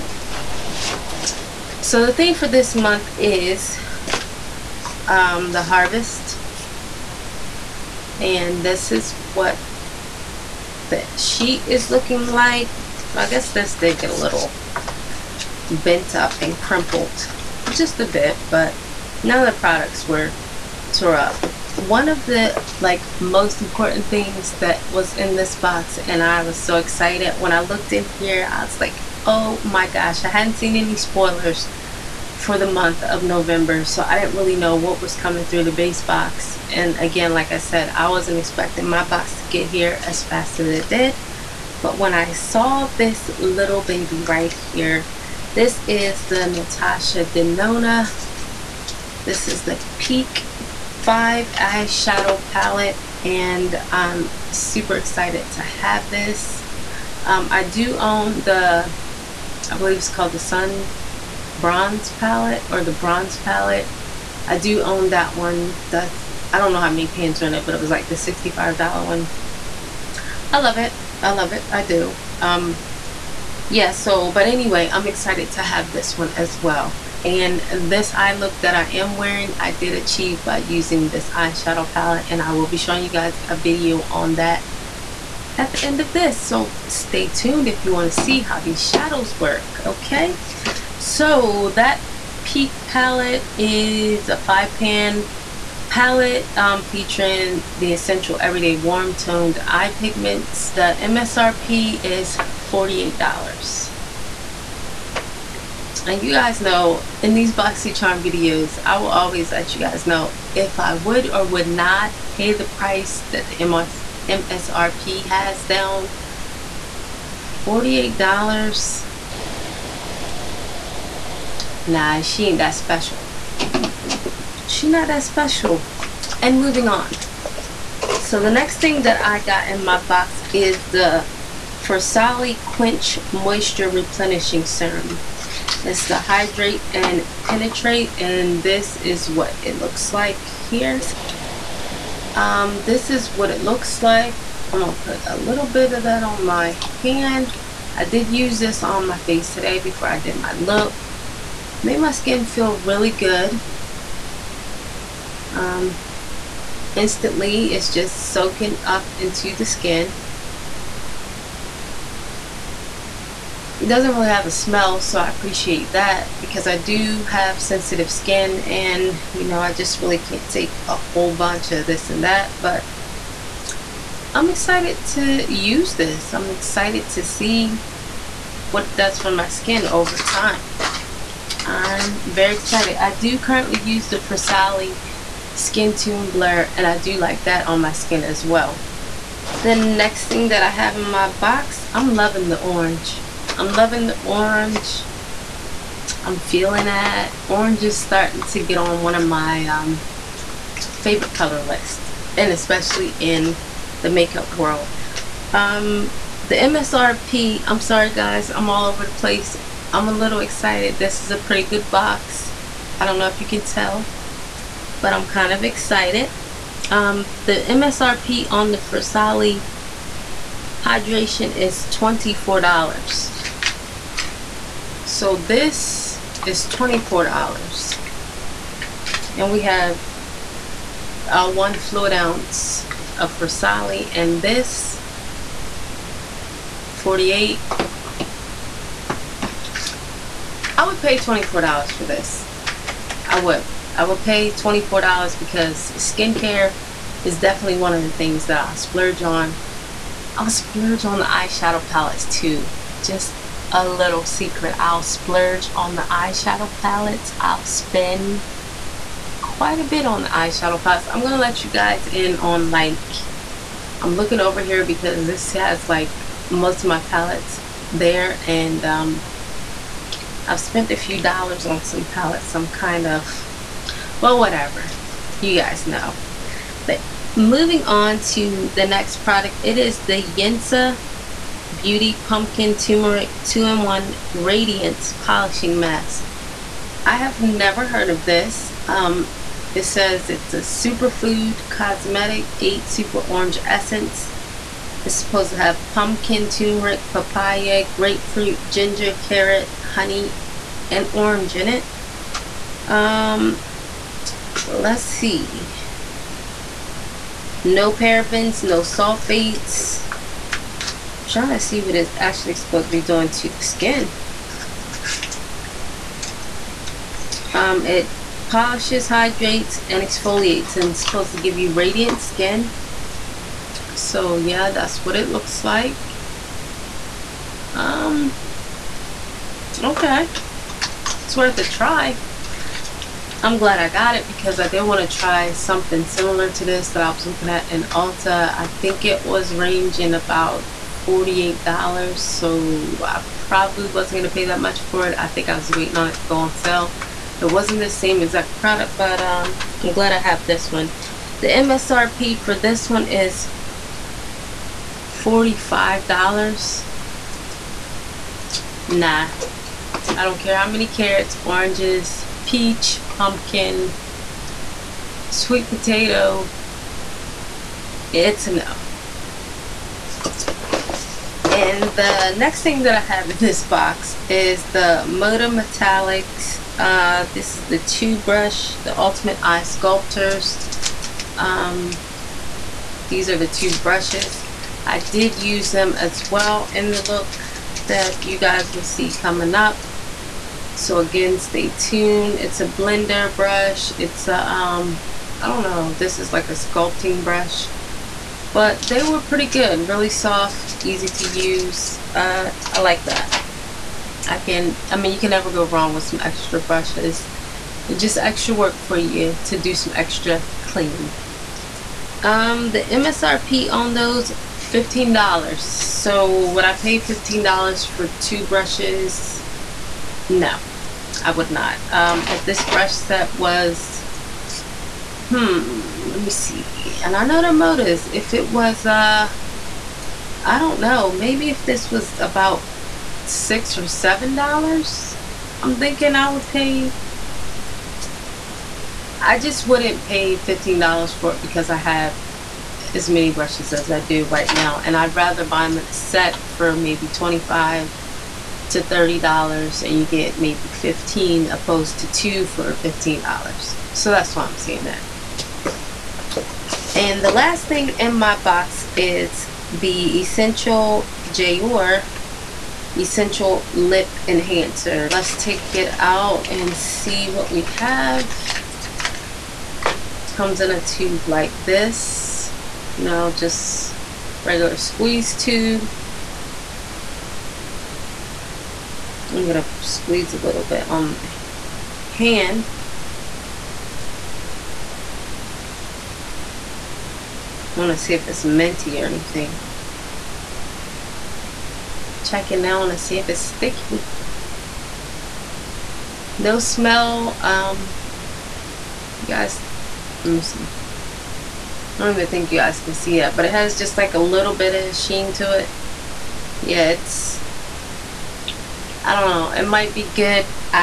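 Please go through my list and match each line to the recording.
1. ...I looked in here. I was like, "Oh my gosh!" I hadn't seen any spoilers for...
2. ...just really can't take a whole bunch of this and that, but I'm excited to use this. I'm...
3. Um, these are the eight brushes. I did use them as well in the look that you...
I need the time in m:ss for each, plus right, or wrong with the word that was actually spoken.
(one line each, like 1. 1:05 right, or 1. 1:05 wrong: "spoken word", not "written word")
1. 0:27 right
2. 2:49 right
3. 6:21 wrong: "two", not "eight".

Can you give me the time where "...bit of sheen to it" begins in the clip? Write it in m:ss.
8:24.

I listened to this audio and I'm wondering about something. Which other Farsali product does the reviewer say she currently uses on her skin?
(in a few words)
Skin Tune Blur.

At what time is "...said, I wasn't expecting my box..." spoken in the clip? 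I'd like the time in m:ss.
0:37.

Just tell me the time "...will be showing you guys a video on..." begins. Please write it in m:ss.
1:22.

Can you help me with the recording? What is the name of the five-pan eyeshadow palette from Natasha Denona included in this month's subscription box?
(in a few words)
Peak 5.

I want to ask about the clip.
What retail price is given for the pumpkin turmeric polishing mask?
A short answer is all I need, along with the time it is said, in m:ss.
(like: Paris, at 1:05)
$45, at 5:55.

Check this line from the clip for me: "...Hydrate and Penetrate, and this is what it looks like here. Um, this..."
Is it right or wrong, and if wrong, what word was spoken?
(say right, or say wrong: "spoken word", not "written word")
right.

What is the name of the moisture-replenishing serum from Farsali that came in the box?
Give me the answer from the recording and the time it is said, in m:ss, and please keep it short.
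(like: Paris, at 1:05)
Quench, at 2:12.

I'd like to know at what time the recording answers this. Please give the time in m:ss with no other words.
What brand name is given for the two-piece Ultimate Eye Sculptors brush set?
6:15.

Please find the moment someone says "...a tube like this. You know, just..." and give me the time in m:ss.
7:50.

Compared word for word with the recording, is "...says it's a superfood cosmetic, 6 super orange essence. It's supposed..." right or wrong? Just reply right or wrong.
wrong.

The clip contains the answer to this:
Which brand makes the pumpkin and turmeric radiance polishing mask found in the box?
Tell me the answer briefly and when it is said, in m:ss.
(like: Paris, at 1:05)
Yensa Beauty, at 4:40.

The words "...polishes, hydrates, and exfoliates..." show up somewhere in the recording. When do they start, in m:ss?
5:18.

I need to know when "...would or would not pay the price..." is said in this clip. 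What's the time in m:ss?
1:50.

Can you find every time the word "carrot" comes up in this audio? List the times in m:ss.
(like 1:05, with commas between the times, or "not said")
4:59, 6:00.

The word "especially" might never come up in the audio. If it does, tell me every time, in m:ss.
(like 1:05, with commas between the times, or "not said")
3:22.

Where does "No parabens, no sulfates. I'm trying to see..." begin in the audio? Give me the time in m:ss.
5:07.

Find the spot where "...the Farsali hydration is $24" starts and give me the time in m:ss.
3:38.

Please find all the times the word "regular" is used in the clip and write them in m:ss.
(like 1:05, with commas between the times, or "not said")
7:54.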